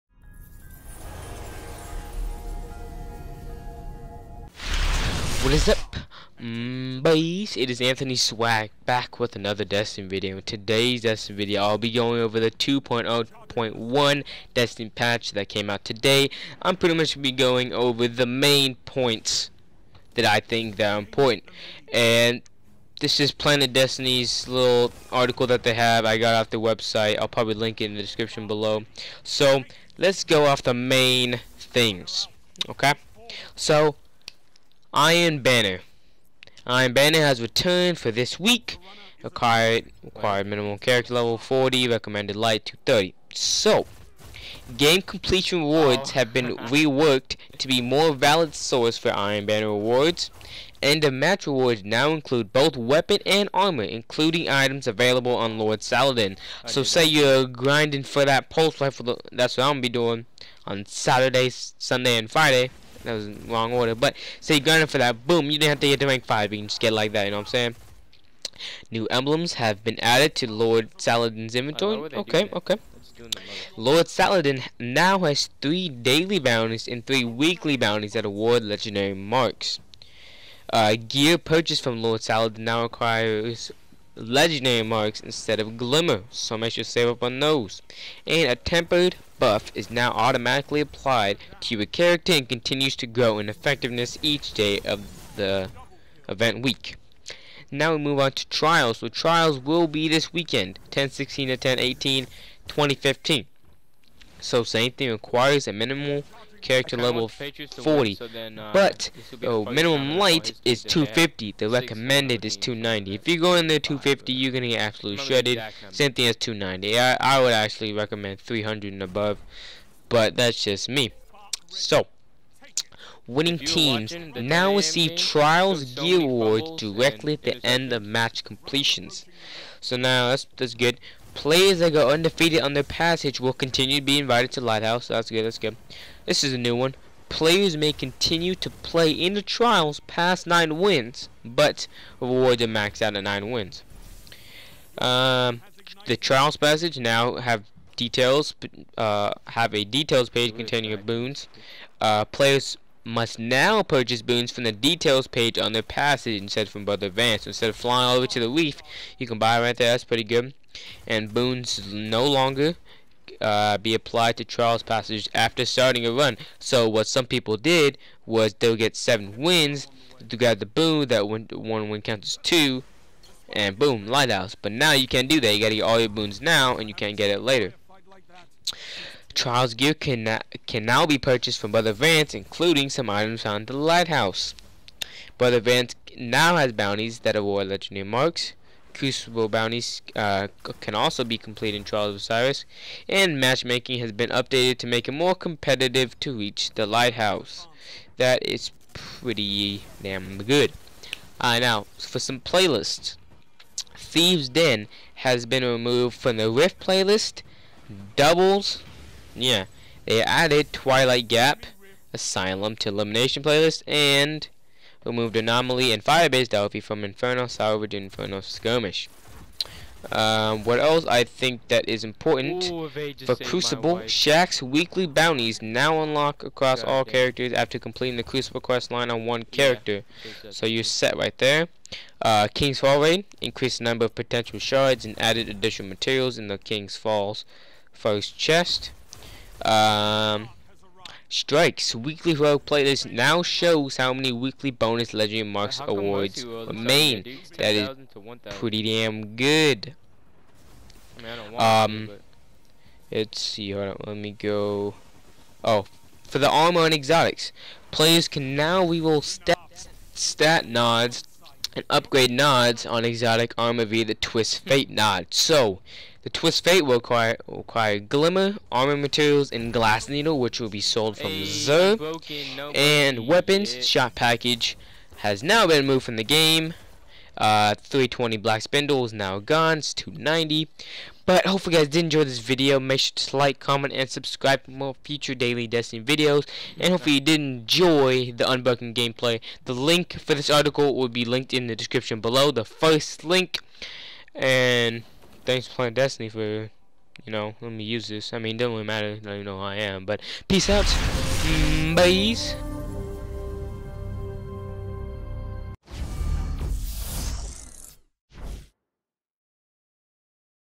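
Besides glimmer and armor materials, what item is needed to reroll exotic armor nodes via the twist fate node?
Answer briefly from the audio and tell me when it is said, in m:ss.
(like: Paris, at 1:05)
glass needle, at 4:29.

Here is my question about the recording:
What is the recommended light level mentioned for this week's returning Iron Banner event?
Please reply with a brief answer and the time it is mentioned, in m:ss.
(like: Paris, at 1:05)
230, at 0:41.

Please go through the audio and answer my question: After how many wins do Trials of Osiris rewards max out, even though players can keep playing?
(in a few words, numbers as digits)
9.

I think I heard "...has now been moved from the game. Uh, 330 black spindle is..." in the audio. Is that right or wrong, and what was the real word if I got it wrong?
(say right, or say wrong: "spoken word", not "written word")
wrong: "320", not "330".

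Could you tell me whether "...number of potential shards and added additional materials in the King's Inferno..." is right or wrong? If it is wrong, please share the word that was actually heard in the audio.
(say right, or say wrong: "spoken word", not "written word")
wrong: "Falls", not "Inferno".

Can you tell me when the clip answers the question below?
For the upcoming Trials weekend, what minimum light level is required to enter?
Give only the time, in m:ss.
1:49.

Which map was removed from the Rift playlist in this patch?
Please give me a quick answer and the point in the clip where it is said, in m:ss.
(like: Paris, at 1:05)
Thieves Den, at 3:23.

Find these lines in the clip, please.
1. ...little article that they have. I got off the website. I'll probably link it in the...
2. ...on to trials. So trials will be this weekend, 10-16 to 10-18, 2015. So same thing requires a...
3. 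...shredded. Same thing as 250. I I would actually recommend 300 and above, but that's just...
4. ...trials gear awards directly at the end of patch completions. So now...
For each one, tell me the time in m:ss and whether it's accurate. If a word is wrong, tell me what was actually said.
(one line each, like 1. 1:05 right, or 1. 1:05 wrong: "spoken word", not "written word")
1. 0:24 right
2. 1:38 right
3. 1:55 wrong: "290", not "250"
4. 2:05 wrong: "match", not "patch".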